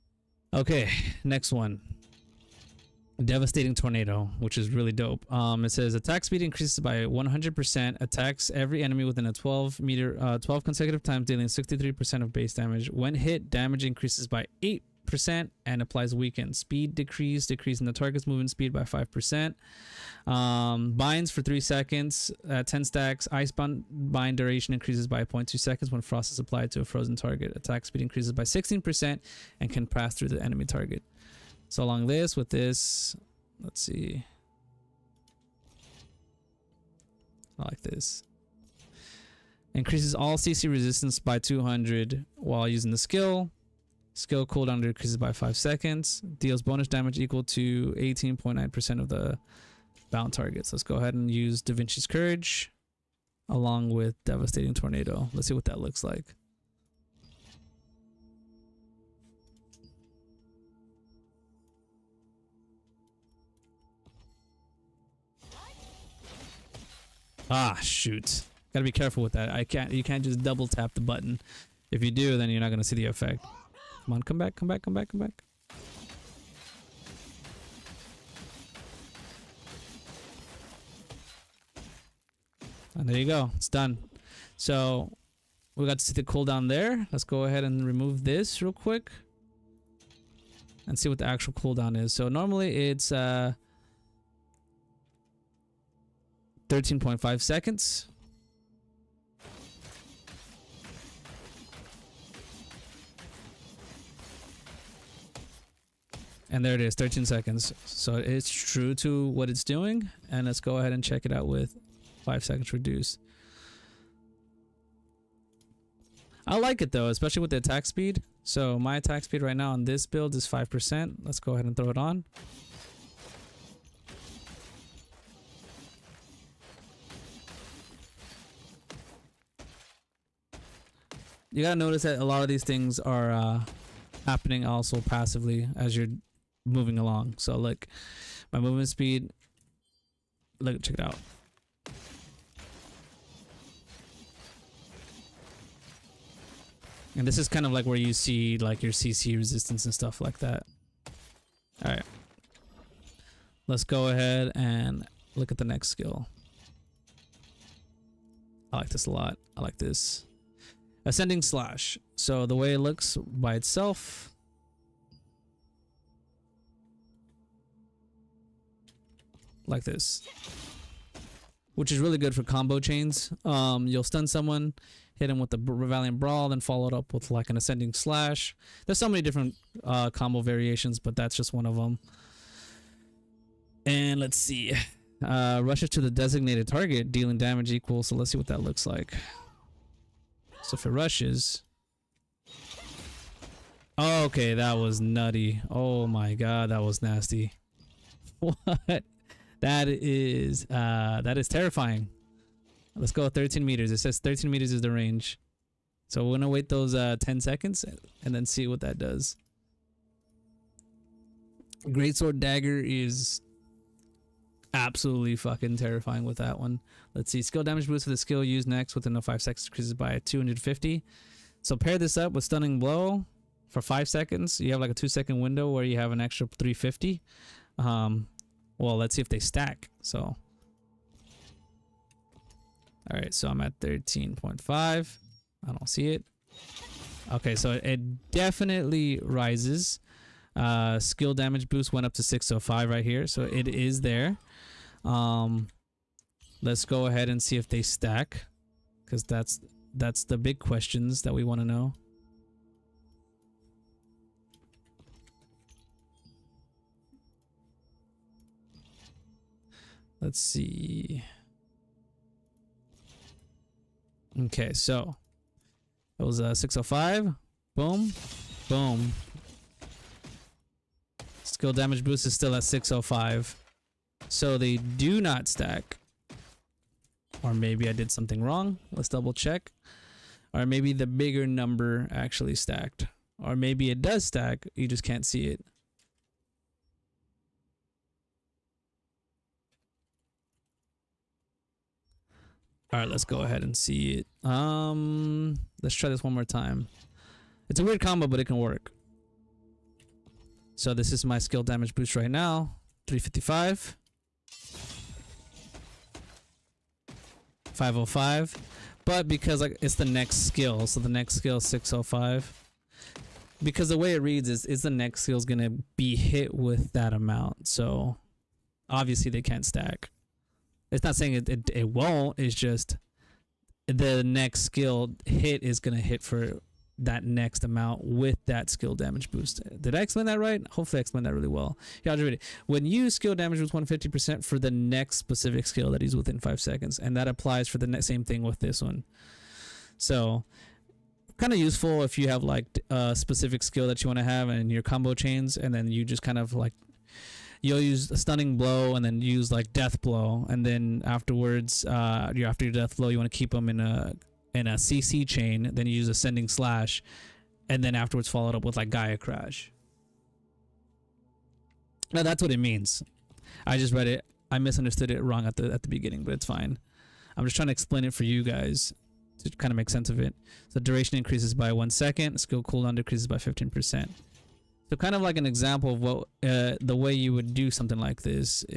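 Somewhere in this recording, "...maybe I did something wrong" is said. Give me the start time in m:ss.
4:37.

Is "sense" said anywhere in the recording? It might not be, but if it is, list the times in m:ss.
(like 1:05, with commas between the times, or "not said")
6:09.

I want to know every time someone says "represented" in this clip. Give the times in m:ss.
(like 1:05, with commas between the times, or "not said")
not said.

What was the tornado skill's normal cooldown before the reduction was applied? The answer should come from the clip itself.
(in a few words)
13.5 seconds.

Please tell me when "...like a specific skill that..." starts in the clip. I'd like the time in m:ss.
5:42.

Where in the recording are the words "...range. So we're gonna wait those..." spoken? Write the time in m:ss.
3:24.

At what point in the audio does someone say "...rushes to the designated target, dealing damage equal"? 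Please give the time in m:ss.
3:05.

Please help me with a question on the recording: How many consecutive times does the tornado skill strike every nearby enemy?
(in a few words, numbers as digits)
12.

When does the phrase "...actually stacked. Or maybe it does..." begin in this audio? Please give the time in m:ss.
4:42.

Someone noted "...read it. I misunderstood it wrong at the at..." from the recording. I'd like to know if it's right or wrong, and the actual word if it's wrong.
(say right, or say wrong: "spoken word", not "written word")
right.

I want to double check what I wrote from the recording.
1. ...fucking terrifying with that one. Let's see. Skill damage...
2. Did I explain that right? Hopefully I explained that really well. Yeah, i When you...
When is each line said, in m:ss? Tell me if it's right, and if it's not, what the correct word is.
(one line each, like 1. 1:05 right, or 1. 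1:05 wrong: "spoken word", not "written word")
1. 3:35 right
2. 5:29 right.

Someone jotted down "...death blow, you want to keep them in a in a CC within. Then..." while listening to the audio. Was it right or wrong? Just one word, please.
wrong.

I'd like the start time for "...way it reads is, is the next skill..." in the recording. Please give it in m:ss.
5:13.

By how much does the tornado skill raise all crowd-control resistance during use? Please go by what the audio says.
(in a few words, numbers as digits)
200.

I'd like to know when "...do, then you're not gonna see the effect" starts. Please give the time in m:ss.
1:12.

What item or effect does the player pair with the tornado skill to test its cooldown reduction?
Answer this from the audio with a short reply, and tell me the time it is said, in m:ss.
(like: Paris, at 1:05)
Da Vinci's Courage, at 0:51.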